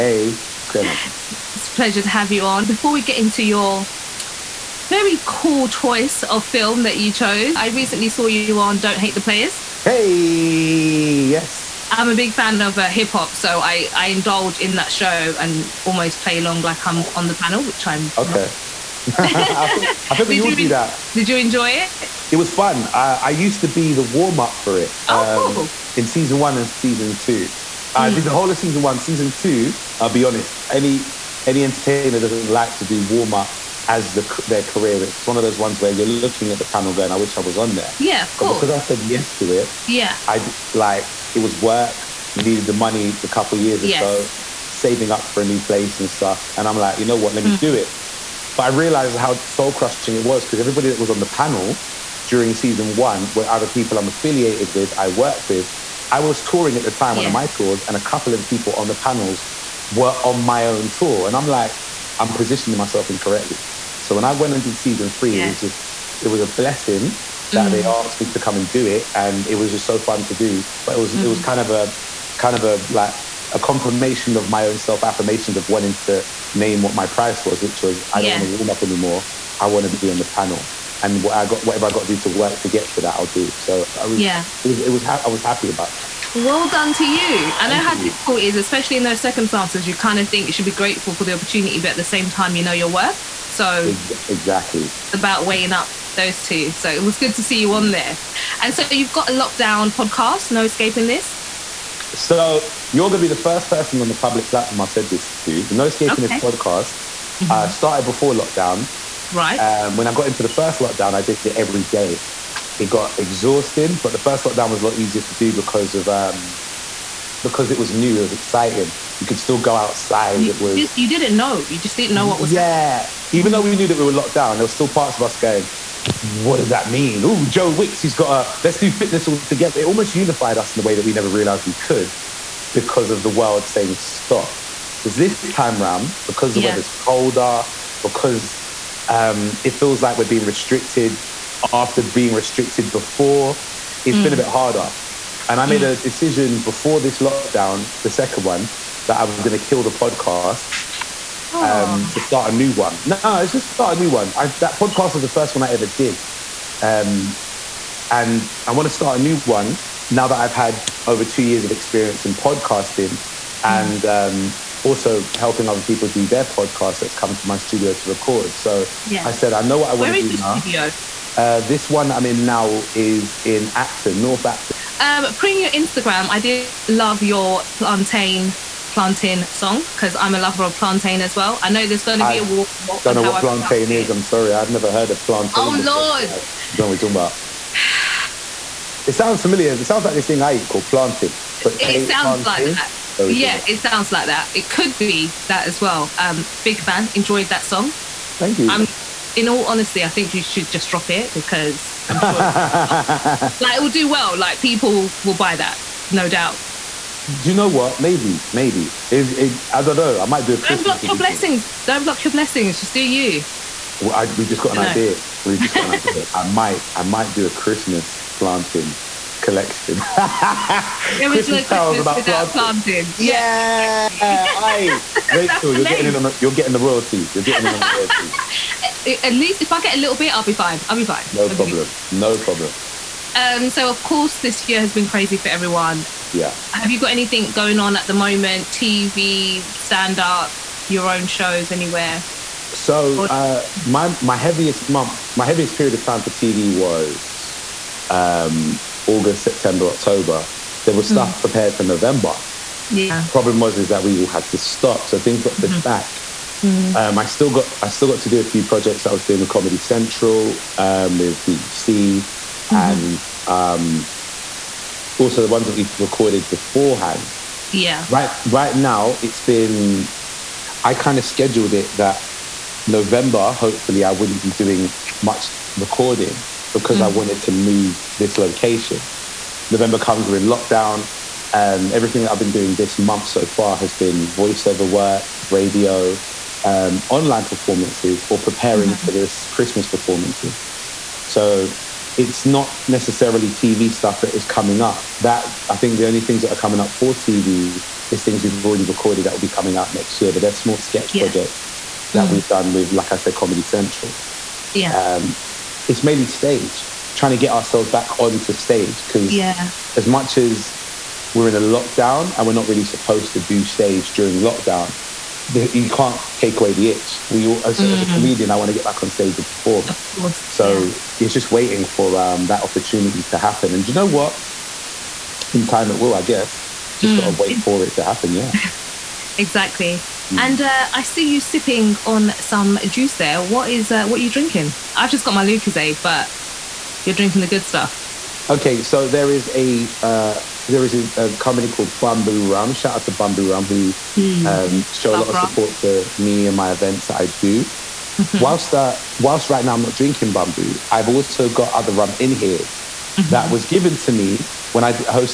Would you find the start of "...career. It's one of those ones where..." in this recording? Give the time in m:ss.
0:34.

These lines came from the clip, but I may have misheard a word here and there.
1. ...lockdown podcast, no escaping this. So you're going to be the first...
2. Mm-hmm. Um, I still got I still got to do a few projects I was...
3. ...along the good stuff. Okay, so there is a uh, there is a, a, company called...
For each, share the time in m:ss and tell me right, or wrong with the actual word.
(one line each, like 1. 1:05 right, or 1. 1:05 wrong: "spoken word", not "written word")
1. 1:39 right
2. 4:16 right
3. 5:37 wrong: "drinking", not "along".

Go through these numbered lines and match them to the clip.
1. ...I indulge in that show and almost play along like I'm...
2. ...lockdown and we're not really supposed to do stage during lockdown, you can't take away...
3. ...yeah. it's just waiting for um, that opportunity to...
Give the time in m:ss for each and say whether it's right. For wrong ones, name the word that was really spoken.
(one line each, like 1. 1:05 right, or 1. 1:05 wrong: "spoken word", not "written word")
1. 0:13 right
2. 5:11 right
3. 5:20 right.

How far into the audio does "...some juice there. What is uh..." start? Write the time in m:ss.
5:32.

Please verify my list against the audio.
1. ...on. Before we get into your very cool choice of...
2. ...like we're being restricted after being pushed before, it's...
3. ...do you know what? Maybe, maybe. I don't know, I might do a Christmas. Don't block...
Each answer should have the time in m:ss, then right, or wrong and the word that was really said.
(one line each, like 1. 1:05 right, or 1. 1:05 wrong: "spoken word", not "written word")
1. 0:02 right
2. 2:20 wrong: "restricted", not "pushed"
3. 3:27 right.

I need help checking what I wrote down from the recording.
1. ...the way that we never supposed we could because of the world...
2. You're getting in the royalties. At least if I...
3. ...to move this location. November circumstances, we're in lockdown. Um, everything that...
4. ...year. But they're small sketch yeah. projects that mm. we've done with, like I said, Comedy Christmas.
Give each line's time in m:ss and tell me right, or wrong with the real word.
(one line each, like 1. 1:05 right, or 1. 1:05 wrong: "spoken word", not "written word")
1. 2:10 wrong: "realized", not "supposed"
2. 3:47 right
3. 4:37 wrong: "comes", not "circumstances"
4. 5:00 wrong: "Central", not "Christmas".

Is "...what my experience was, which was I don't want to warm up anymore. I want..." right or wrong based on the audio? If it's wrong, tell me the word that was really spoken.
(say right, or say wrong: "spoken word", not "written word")
wrong: "price", not "experience".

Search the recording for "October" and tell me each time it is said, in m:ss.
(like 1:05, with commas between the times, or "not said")
4:09.